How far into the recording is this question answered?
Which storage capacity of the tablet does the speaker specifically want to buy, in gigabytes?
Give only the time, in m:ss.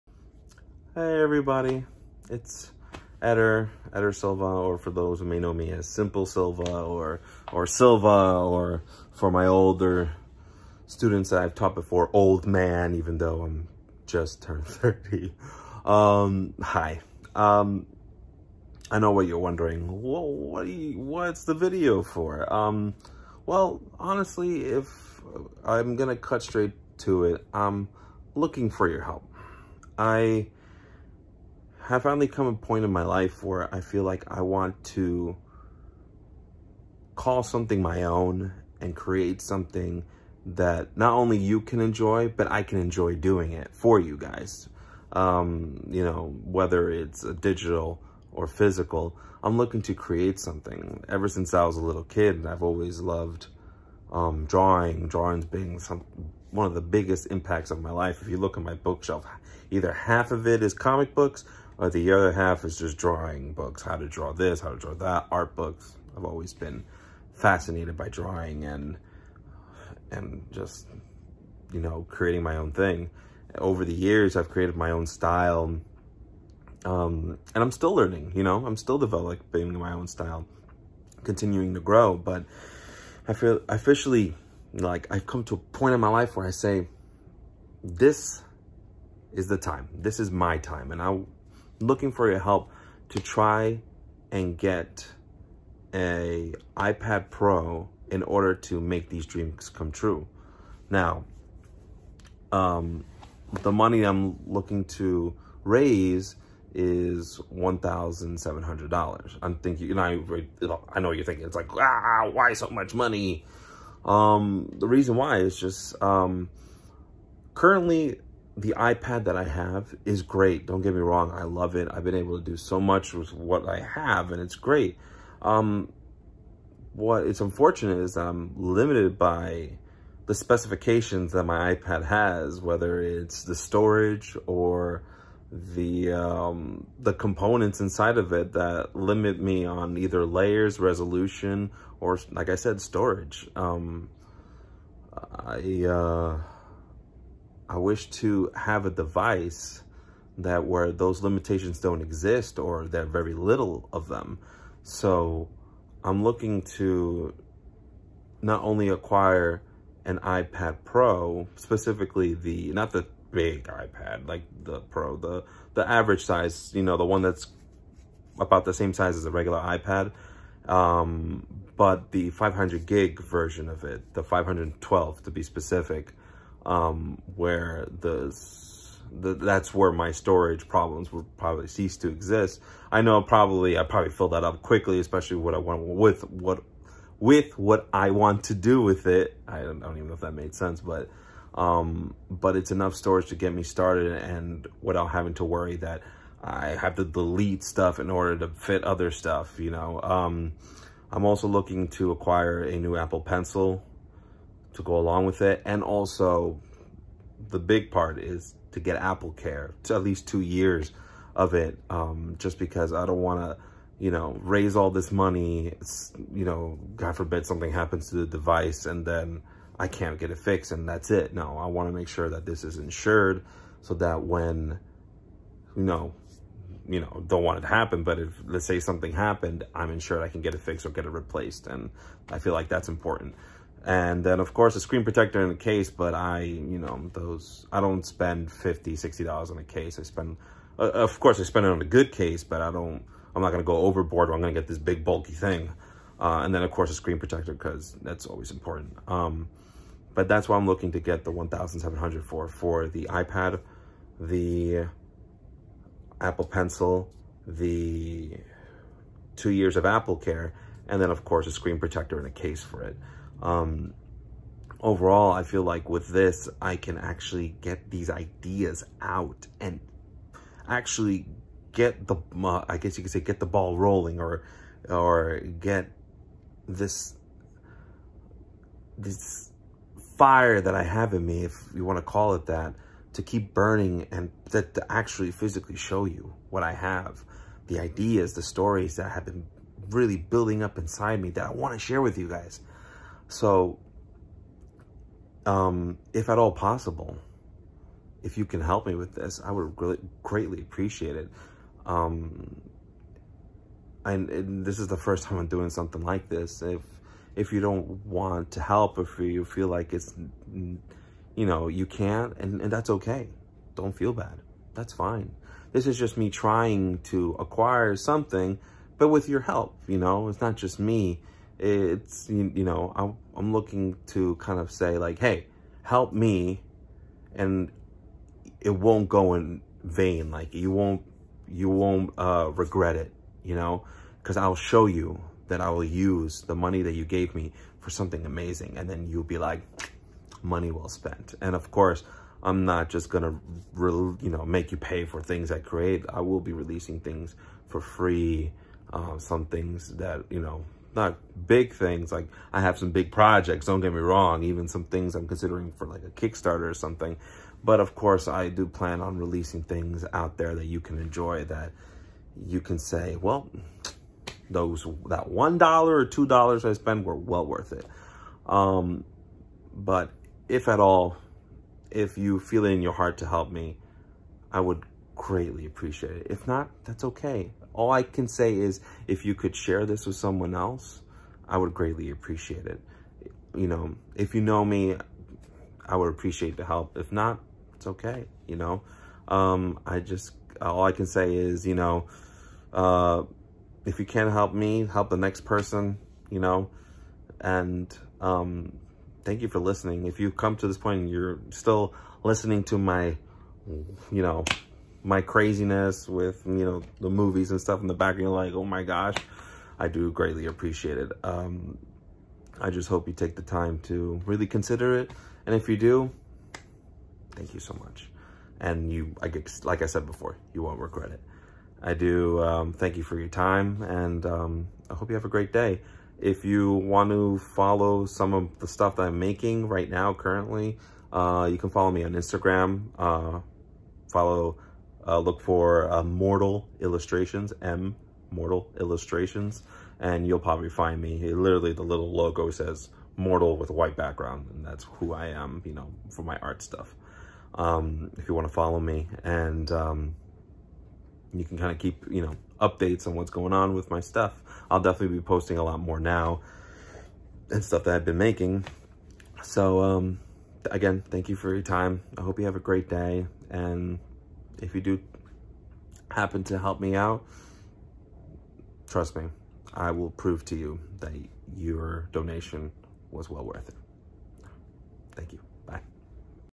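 2:54.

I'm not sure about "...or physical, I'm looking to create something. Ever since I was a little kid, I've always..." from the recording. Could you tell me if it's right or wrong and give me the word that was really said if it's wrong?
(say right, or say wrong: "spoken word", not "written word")
right.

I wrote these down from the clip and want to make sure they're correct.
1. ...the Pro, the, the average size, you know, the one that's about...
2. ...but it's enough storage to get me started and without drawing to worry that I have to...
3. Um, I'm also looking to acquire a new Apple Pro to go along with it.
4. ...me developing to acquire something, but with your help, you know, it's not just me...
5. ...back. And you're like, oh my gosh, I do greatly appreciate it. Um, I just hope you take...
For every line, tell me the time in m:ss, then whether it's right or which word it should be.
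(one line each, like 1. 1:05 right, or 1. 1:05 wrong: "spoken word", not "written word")
1. 2:44 right
2. 3:12 wrong: "having", not "drawing"
3. 3:20 wrong: "Pencil", not "Pro"
4. 5:16 wrong: "trying", not "developing"
5. 6:47 right.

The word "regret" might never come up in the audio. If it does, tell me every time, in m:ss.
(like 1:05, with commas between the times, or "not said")
5:32, 7:00.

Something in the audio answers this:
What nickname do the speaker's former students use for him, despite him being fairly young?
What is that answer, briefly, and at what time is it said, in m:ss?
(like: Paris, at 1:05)
Old Man, at 0:12.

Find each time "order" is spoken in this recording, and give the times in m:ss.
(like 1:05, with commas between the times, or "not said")
1:38, 3:18.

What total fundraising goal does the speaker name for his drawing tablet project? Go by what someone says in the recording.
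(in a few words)
$1,700.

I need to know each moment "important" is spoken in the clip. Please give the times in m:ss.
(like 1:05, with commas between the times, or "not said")
3:52, 4:08.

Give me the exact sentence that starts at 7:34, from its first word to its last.
I'll definitely be posting a lot more now and stuff that I've been making.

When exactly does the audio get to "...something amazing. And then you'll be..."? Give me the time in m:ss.
5:37.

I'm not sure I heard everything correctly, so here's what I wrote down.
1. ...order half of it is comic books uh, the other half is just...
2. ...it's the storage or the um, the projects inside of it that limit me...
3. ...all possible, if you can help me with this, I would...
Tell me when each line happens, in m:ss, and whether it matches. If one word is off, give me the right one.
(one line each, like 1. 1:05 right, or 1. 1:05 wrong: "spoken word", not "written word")
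1. 0:59 wrong: "either", not "order"
2. 2:13 wrong: "components", not "projects"
3. 4:56 right.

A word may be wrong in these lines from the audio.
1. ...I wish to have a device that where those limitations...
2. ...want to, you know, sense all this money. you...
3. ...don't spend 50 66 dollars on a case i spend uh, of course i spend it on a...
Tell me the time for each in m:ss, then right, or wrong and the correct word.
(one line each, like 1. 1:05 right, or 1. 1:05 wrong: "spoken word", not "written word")
1. 2:27 right
2. 3:33 wrong: "raise", not "sense"
3. 3:57 wrong: "60", not "66".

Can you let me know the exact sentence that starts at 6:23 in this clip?
You know, if you know me, I would appreciate the help.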